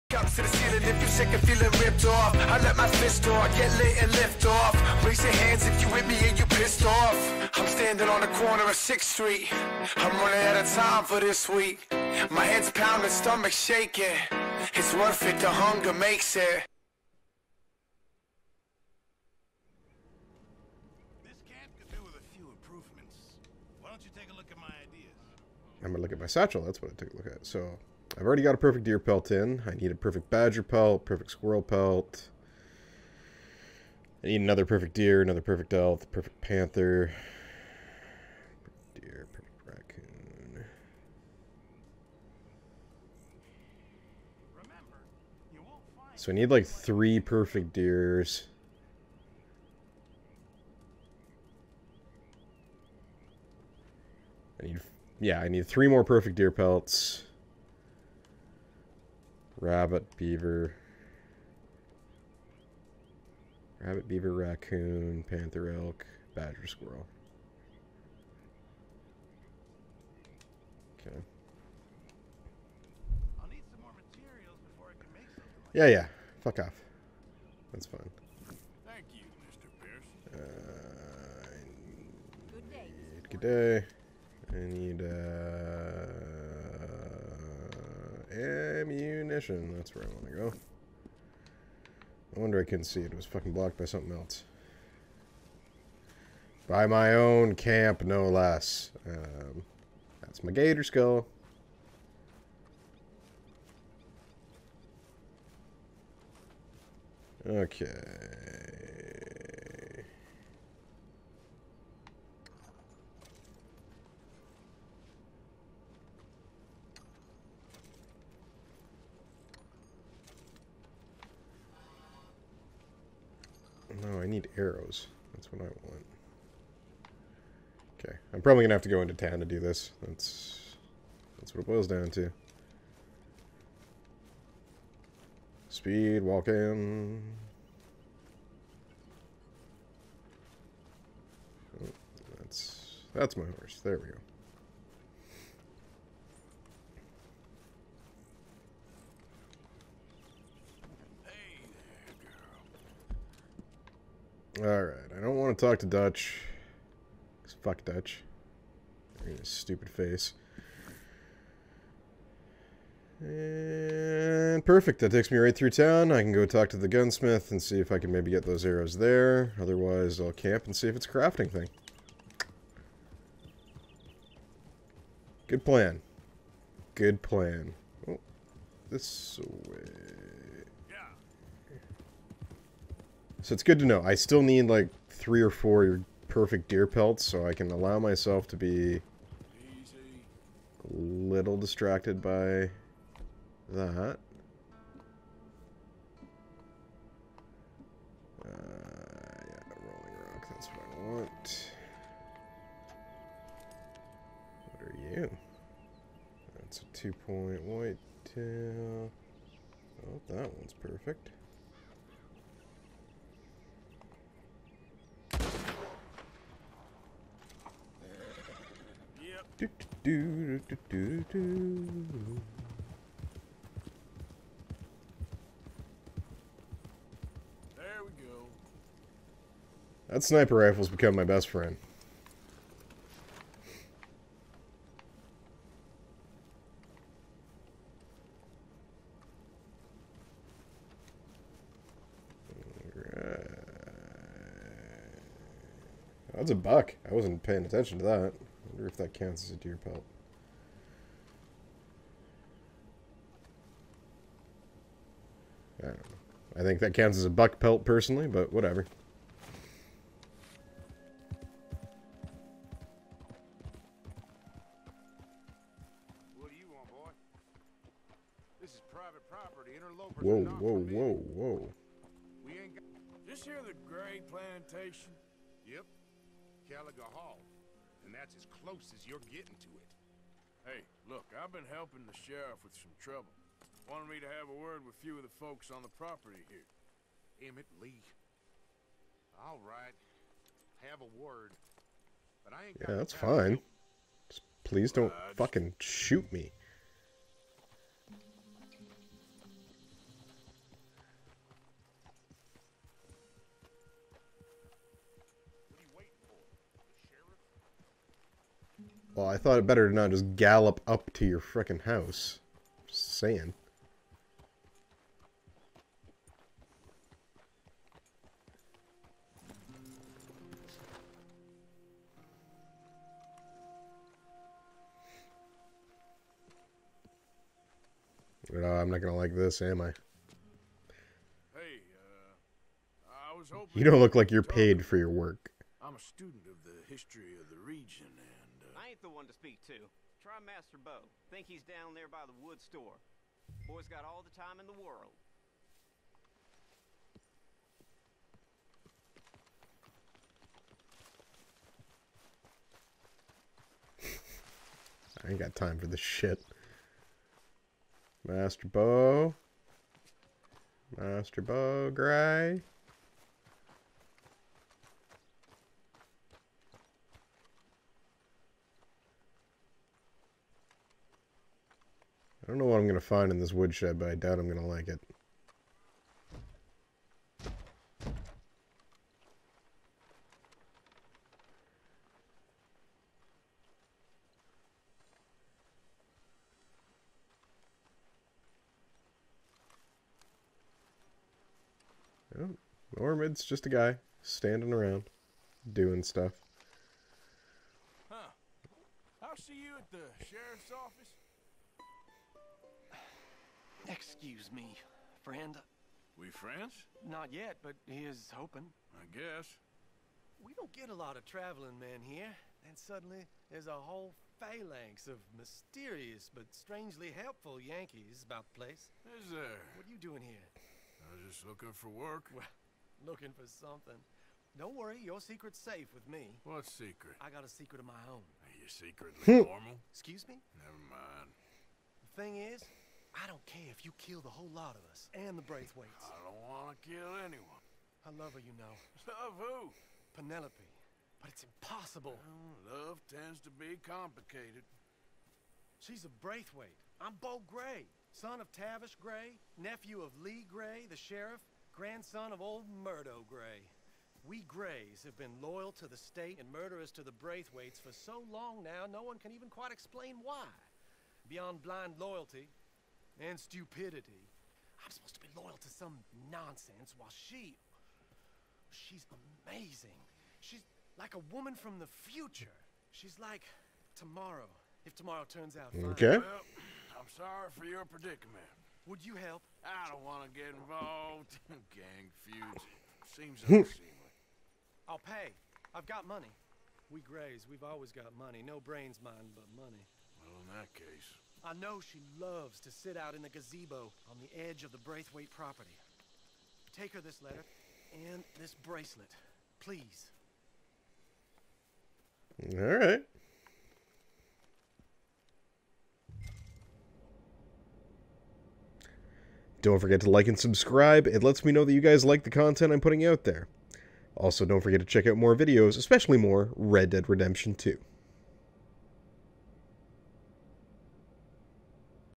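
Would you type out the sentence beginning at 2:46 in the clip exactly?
I can go talk to the gunsmith and see if I can maybe get those arrows there.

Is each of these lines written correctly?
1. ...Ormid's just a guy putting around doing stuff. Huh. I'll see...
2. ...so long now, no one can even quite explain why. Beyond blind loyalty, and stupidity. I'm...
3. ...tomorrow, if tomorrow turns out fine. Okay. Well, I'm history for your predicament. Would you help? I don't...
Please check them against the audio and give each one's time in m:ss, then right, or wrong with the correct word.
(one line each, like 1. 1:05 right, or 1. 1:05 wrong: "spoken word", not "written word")
1. 6:32 wrong: "standing", not "putting"
2. 7:37 right
3. 7:53 wrong: "sorry", not "history".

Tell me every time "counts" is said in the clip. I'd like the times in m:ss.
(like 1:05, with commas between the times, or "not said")
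4:09, 4:16.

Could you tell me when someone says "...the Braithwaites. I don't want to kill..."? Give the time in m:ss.
7:15.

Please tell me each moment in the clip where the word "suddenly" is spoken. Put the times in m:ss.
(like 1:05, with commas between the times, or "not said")
6:52.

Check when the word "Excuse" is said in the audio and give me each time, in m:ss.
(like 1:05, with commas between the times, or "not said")
6:43, 7:09.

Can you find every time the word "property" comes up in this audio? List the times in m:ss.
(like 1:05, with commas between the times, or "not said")
4:29, 4:45, 8:15.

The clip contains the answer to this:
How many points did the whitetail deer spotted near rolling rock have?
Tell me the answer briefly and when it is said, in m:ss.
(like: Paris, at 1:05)
2, at 3:26.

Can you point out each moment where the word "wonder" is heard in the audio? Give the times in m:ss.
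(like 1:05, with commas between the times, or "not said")
1:32, 4:08.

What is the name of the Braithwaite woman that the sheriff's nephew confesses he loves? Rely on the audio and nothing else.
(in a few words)
Penelope.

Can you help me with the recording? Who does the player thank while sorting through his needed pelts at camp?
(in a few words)
Mr. Pierce.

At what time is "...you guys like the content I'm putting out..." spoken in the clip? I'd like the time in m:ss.
8:31.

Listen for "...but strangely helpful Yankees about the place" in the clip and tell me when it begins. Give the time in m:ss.
6:56.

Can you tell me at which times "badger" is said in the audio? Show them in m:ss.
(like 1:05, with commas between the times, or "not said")
0:30, 1:06.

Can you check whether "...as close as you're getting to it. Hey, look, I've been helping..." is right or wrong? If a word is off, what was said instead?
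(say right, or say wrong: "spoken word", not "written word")
right.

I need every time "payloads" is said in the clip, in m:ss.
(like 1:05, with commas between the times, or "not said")
not said.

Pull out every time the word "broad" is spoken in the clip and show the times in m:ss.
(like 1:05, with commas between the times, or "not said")
not said.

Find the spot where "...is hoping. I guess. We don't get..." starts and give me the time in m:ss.
6:48.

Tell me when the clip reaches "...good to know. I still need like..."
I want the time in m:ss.
3:03.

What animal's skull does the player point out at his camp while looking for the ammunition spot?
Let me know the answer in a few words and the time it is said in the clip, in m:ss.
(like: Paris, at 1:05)
gator, at 1:40.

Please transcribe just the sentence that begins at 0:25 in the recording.
I'm gonna look at my satchel.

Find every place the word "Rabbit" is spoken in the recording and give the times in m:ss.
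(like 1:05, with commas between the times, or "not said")
0:59, 1:03.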